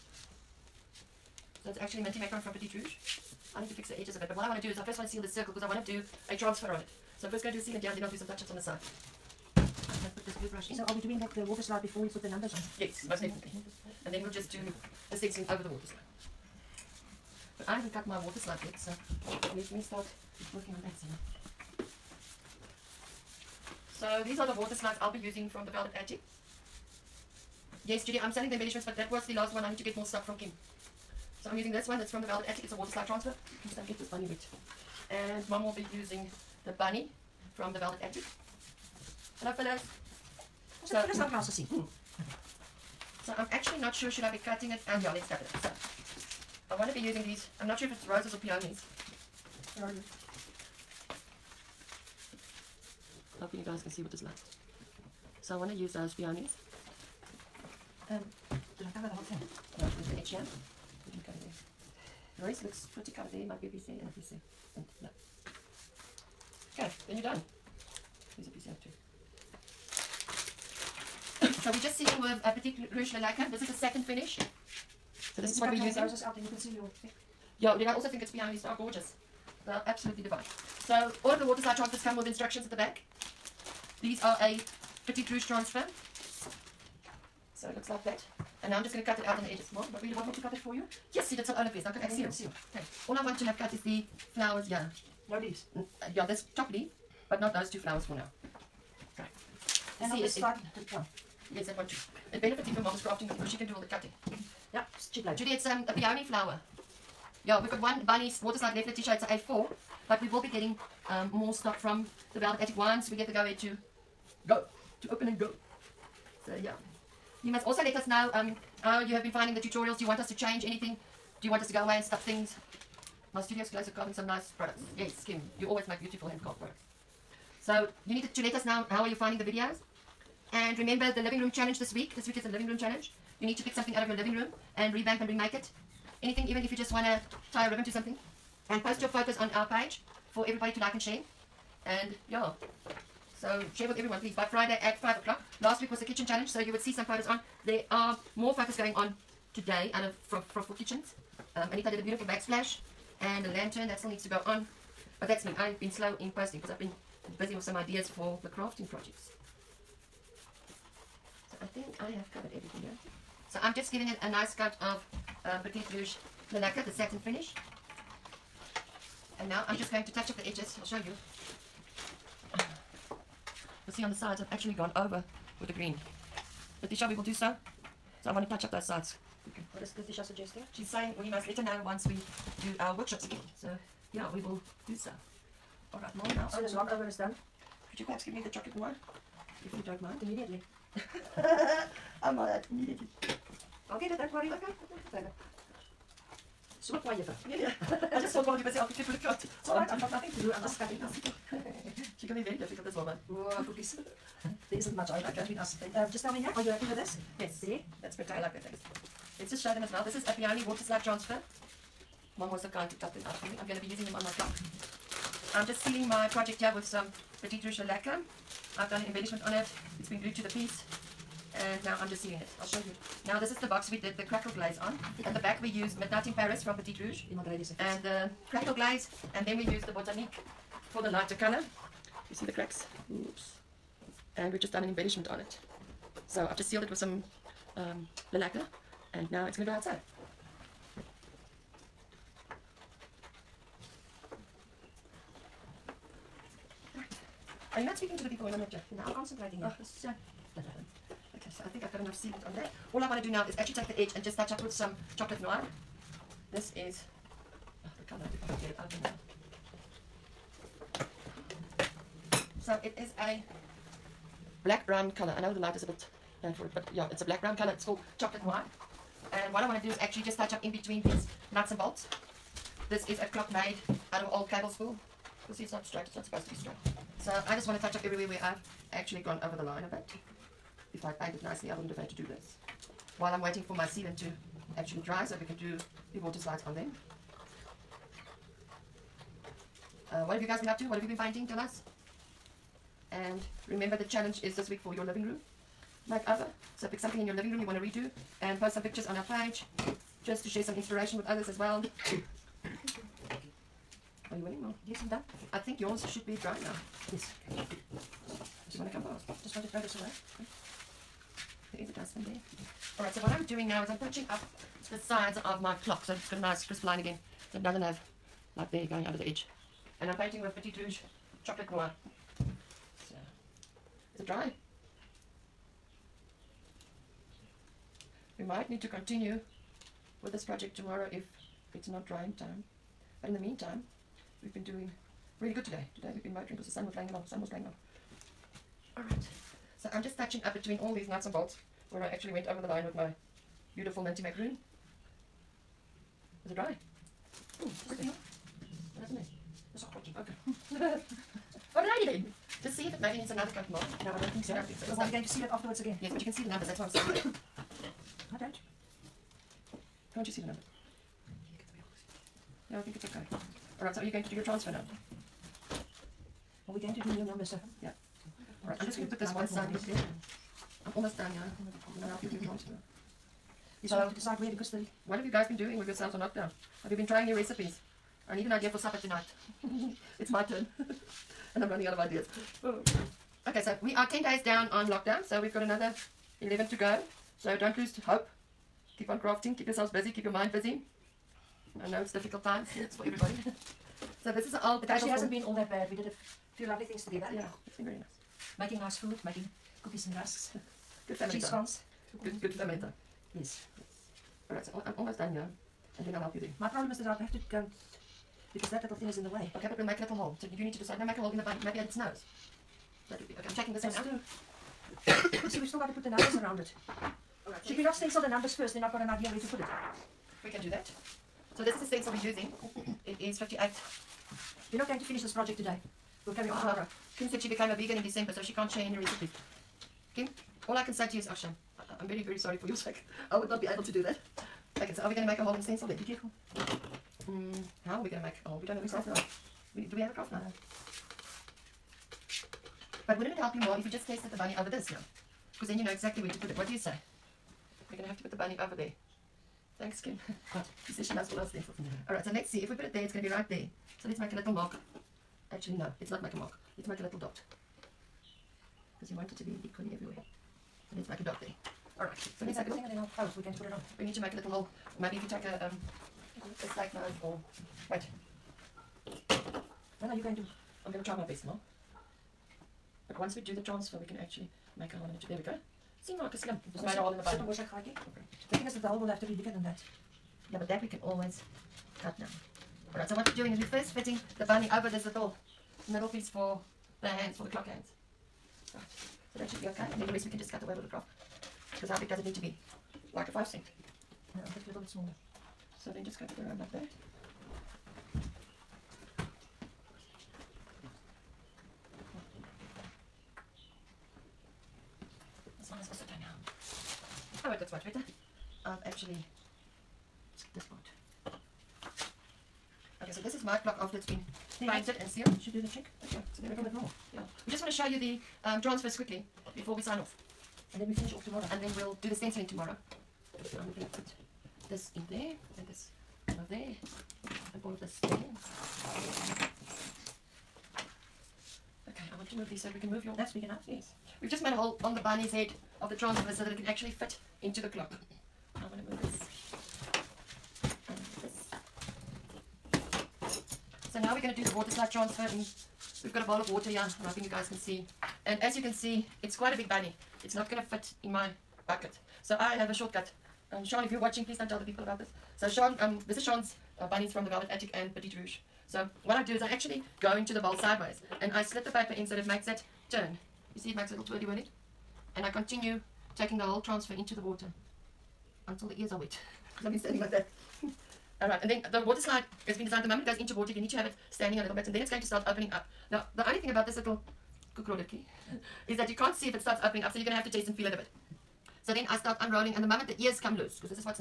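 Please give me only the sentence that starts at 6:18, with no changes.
I need an idea for supper tonight.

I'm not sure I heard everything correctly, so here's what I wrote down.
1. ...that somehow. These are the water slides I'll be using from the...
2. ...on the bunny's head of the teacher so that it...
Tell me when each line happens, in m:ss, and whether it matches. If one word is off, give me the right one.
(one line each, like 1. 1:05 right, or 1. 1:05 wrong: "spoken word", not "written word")
1. 0:20 right
2. 8:54 wrong: "transfer", not "teacher".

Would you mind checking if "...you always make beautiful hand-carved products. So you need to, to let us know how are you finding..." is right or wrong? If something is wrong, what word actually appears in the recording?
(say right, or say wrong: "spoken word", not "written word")
right.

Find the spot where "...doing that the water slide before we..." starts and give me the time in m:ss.
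0:10.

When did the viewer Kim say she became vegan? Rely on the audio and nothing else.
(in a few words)
December.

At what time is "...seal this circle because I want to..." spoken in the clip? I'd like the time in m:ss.
0:05.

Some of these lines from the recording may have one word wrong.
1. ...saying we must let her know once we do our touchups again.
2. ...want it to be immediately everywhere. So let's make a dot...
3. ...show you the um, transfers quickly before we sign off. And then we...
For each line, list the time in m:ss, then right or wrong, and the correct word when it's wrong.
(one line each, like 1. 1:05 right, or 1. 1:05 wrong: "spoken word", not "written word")
1. 3:00 wrong: "workshops", not "touchups"
2. 7:39 wrong: "equally", not "immediately"
3. 8:37 right.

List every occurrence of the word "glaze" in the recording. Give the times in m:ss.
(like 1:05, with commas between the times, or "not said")
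3:44, 3:48.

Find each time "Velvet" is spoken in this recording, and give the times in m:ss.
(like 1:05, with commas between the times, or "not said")
0:25, 0:32, 0:37, 1:52, 9:17.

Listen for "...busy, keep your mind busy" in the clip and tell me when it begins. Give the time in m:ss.
6:29.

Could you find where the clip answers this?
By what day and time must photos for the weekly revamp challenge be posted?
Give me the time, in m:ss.
2:24.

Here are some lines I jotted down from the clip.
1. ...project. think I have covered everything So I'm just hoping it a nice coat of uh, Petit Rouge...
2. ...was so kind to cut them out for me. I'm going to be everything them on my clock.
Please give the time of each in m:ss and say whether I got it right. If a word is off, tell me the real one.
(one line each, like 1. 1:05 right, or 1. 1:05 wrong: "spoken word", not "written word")
1. 2:38 wrong: "giving", not "hoping"
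2. 3:32 wrong: "using", not "everything".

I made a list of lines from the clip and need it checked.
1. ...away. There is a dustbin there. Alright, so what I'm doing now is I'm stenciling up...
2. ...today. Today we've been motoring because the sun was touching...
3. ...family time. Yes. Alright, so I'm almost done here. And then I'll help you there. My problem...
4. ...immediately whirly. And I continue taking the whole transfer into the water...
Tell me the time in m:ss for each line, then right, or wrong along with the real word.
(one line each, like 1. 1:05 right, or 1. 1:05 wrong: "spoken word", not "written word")
1. 5:09 wrong: "touching", not "stenciling"
2. 5:35 wrong: "playing", not "touching"
3. 6:42 right
4. 9:24 wrong: "twirly", not "immediately".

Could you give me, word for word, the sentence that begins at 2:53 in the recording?
You'll see on the sides I've actually gone over with the green.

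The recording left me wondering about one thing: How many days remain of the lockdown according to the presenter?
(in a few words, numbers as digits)
11.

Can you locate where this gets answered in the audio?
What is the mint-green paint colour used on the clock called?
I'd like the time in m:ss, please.
0:02.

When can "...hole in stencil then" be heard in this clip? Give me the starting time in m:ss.
7:15.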